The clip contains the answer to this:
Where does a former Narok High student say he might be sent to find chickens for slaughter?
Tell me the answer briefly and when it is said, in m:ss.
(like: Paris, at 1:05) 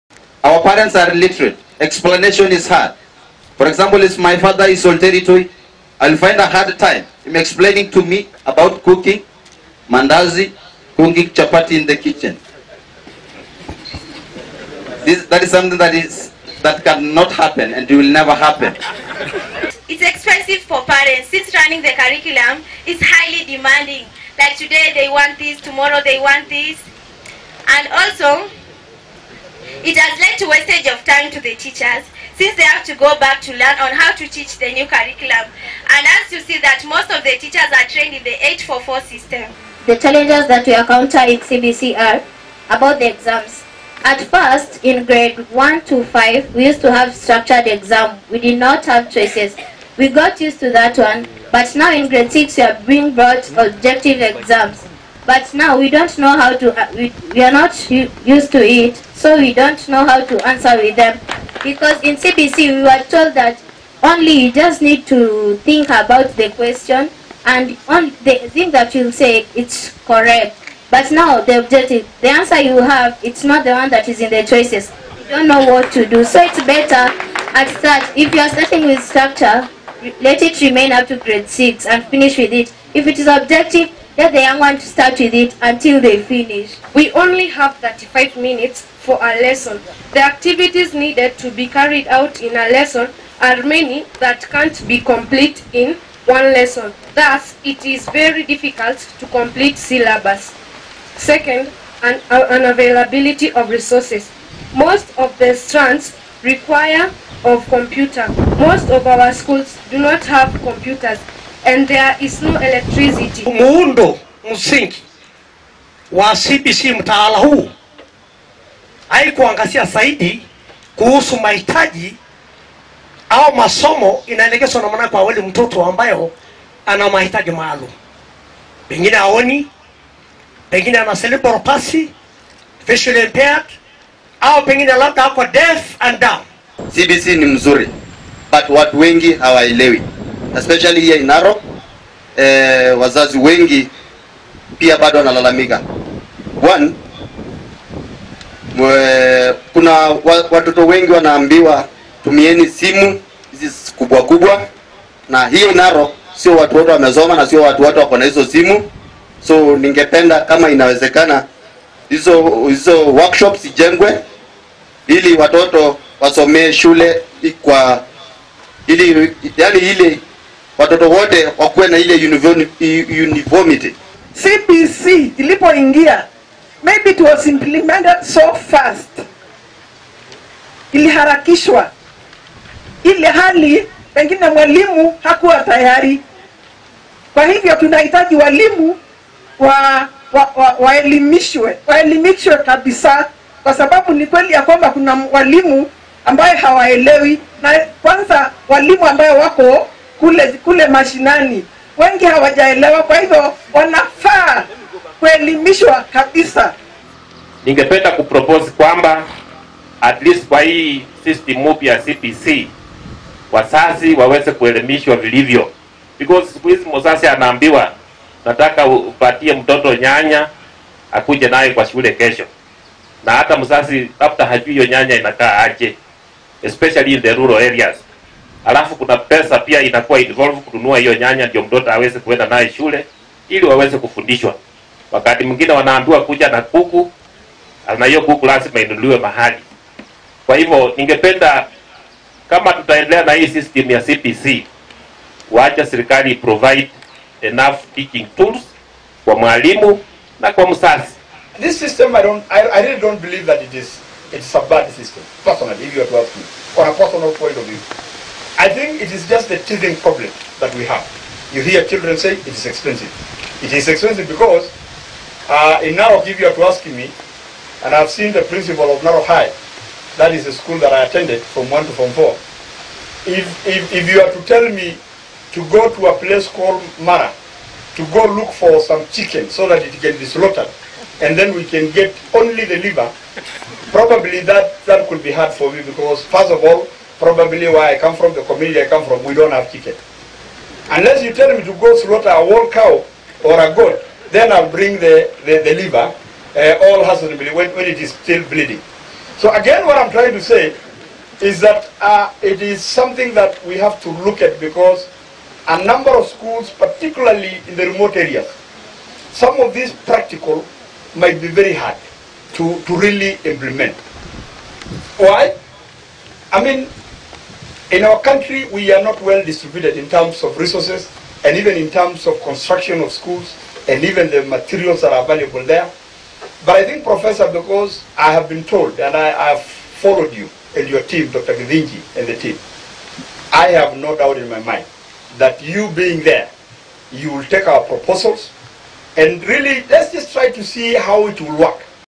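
Mara, at 4:36.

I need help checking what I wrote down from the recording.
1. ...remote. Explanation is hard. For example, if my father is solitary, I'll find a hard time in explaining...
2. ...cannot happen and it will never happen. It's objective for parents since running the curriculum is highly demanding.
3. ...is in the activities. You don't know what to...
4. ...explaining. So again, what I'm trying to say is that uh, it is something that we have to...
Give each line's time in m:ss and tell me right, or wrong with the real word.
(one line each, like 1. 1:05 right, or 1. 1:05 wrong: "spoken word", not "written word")
1. 0:01 wrong: "illiterate", not "remote"
2. 0:16 wrong: "expensive", not "objective"
3. 1:14 wrong: "choices", not "activities"
4. 4:58 wrong: "bleeding", not "explaining".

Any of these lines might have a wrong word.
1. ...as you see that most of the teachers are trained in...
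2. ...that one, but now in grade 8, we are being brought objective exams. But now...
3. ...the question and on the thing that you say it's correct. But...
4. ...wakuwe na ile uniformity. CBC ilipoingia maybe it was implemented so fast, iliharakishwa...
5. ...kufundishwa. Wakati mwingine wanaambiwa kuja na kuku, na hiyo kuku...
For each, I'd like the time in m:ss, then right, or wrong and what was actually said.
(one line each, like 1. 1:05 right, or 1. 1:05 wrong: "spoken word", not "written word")
1. 0:36 right
2. 0:50 wrong: "6", not "8"
3. 1:06 right
4. 2:51 right
5. 3:53 right.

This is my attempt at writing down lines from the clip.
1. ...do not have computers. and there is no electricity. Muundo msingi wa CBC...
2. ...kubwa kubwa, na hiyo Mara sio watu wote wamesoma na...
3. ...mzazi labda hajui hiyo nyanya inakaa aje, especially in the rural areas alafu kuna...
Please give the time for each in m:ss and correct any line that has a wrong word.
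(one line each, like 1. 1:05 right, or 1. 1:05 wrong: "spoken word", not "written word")
1. 1:49 right
2. 2:33 wrong: "Narok", not "Mara"
3. 3:43 right.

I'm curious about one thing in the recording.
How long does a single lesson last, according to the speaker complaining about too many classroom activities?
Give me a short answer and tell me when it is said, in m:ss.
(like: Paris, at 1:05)
35 minutes, at 1:27.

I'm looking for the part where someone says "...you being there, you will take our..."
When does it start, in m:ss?
5:35.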